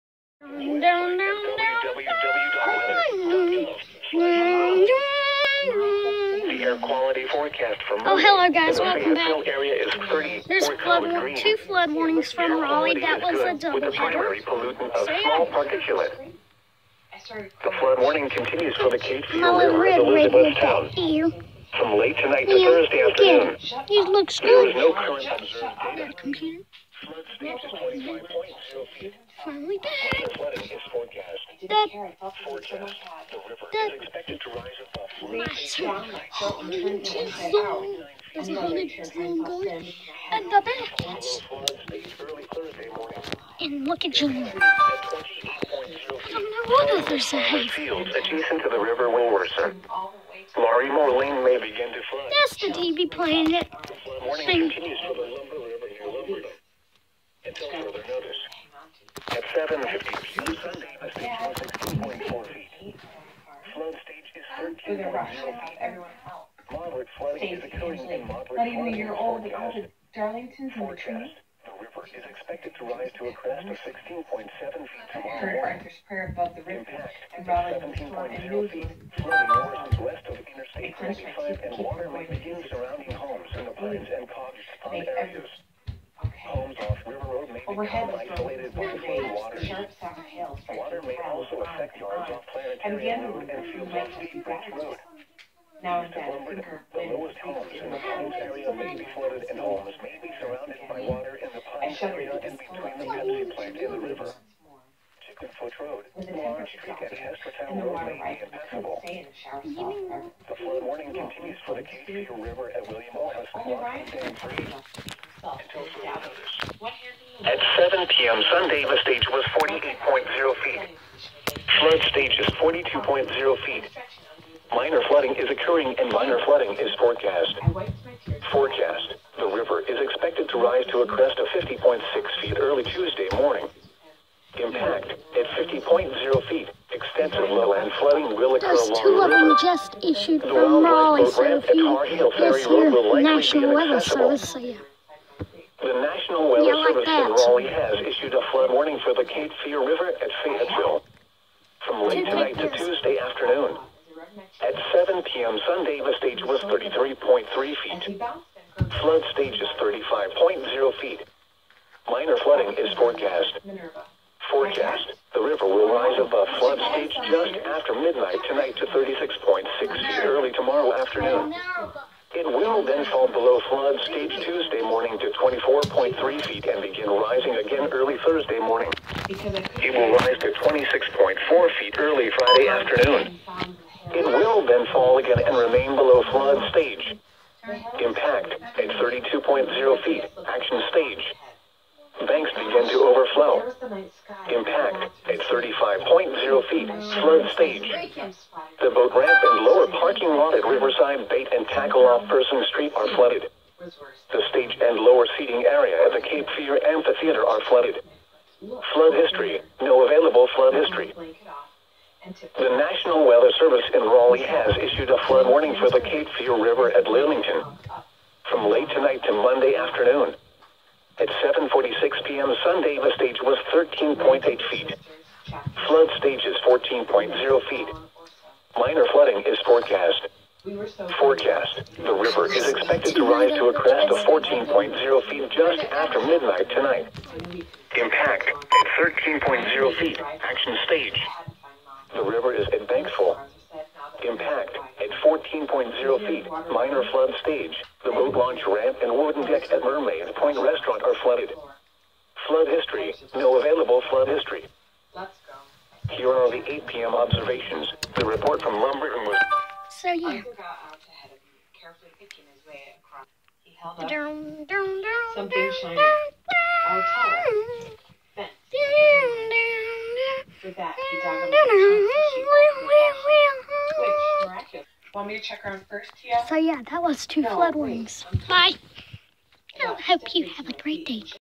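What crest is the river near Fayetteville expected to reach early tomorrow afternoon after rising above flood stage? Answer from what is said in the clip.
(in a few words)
36.6 feet.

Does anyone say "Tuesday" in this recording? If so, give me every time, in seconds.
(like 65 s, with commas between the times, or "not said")
132 s, 152 s, 174 s.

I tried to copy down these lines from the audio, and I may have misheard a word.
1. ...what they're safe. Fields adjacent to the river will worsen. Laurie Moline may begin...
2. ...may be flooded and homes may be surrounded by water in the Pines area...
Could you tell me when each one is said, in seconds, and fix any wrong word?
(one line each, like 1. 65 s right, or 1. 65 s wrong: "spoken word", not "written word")
1. 46 s right
2. 98 s right.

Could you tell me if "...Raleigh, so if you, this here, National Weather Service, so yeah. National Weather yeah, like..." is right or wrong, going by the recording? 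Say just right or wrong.
right.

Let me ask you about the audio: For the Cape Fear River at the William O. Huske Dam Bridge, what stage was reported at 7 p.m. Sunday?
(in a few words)
48.0 feet.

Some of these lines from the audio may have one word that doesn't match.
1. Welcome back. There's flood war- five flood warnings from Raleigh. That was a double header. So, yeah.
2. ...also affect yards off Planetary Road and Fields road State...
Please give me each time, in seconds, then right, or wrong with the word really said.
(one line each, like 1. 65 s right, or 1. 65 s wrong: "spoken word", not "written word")
1. 8 s wrong: "two", not "five"
2. 91 s right.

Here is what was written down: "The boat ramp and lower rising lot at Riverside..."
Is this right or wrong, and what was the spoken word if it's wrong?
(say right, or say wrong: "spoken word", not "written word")
wrong: "parking", not "rising".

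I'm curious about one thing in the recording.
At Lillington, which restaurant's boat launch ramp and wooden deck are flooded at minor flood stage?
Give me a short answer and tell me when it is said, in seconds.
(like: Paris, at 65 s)
Mermaid Point Restaurant, at 249 s.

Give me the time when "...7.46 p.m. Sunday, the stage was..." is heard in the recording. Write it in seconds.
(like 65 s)
221 s.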